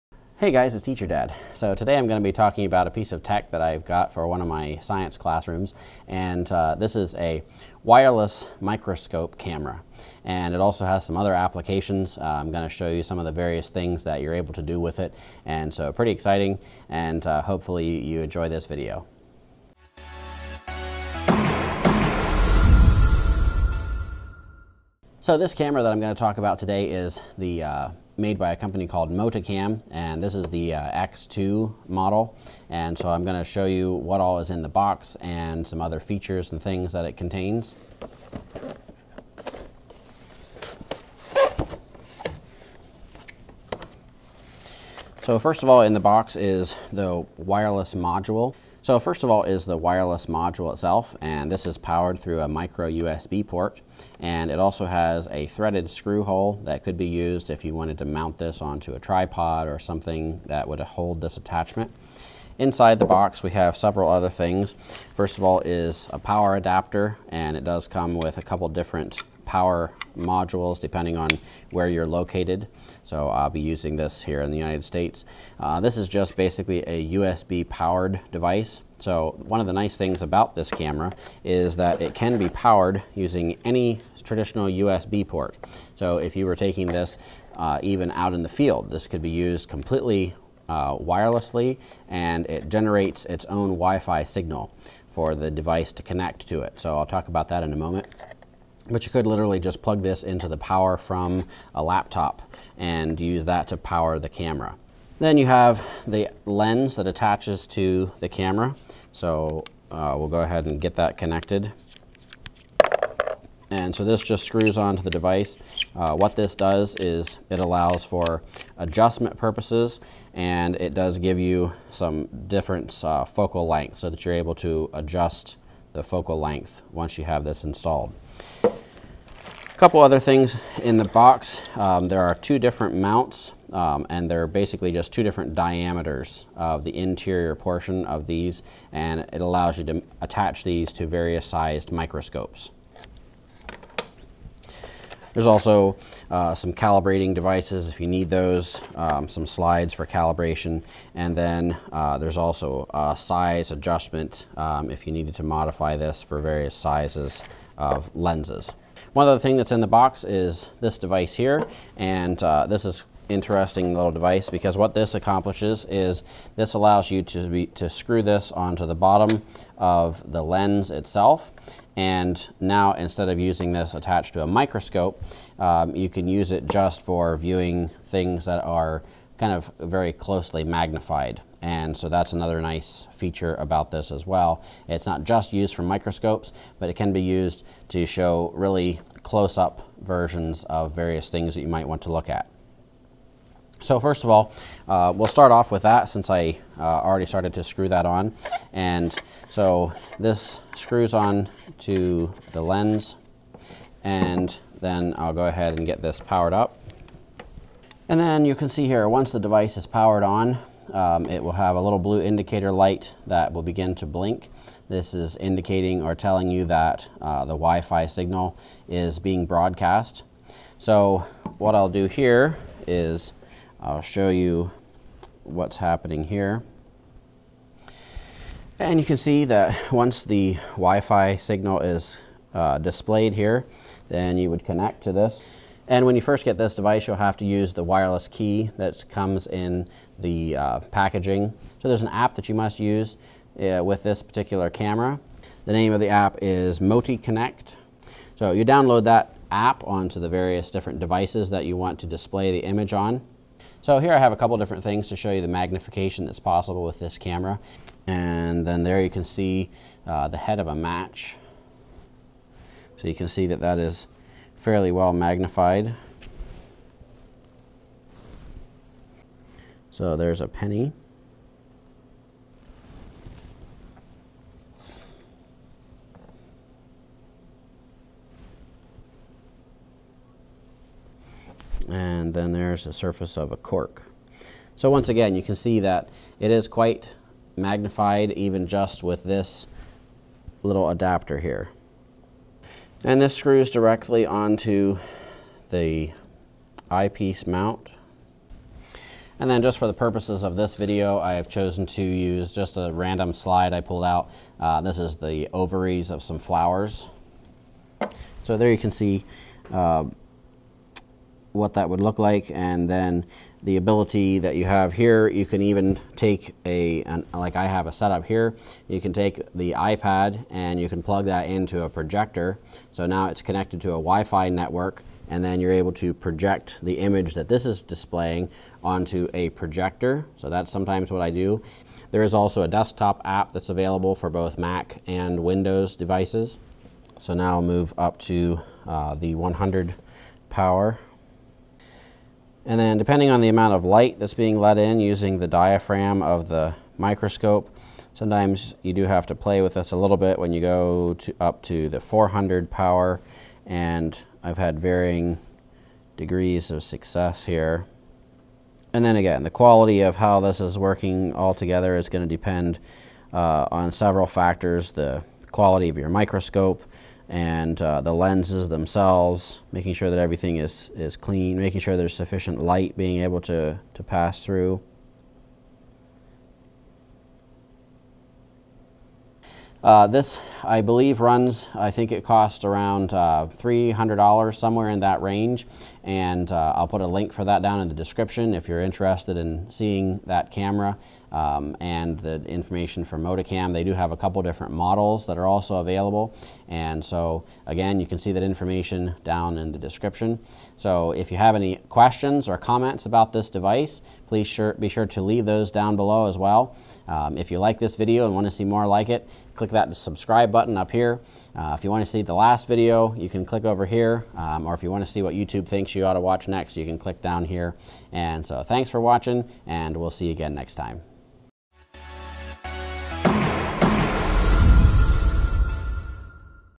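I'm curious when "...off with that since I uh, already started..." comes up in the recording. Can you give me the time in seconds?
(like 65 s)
195 s.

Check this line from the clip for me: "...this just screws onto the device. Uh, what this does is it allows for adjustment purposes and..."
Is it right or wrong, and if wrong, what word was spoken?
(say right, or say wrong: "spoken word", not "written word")
right.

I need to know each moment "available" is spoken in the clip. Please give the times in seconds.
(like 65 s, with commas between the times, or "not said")
333 s, 395 s.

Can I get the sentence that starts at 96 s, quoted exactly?
So I'll talk about that in a moment.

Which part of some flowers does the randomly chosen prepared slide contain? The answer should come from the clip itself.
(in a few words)
ovaries.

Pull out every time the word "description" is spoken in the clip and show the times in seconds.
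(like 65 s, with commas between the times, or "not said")
387 s, 399 s.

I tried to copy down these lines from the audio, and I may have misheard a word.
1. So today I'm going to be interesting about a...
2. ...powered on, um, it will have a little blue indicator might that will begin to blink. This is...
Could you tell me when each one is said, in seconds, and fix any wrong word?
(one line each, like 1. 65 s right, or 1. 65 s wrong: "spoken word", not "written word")
1. 1 s wrong: "talking", not "interesting"
2. 209 s wrong: "light", not "might".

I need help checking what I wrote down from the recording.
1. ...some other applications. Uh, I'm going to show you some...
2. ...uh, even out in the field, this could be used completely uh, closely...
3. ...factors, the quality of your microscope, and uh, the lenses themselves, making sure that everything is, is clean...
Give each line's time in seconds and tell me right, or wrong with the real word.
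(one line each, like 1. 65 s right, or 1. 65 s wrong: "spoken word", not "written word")
1. 11 s right
2. 87 s wrong: "wirelessly", not "closely"
3. 364 s right.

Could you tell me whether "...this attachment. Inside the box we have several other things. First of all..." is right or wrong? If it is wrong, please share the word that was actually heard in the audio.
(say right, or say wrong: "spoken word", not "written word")
right.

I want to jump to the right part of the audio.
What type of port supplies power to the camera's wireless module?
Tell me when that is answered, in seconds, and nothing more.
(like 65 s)
52 s.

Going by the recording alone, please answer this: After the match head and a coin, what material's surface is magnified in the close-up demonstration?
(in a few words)
cork.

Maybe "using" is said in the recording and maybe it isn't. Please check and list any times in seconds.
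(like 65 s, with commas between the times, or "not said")
73 s, 83 s, 173 s, 344 s.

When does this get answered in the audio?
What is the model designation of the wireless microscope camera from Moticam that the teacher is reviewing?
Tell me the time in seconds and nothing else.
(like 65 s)
31 s.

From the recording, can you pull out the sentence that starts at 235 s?
And when you first get this device, you'll have to use the wireless key that comes in the uh, packaging.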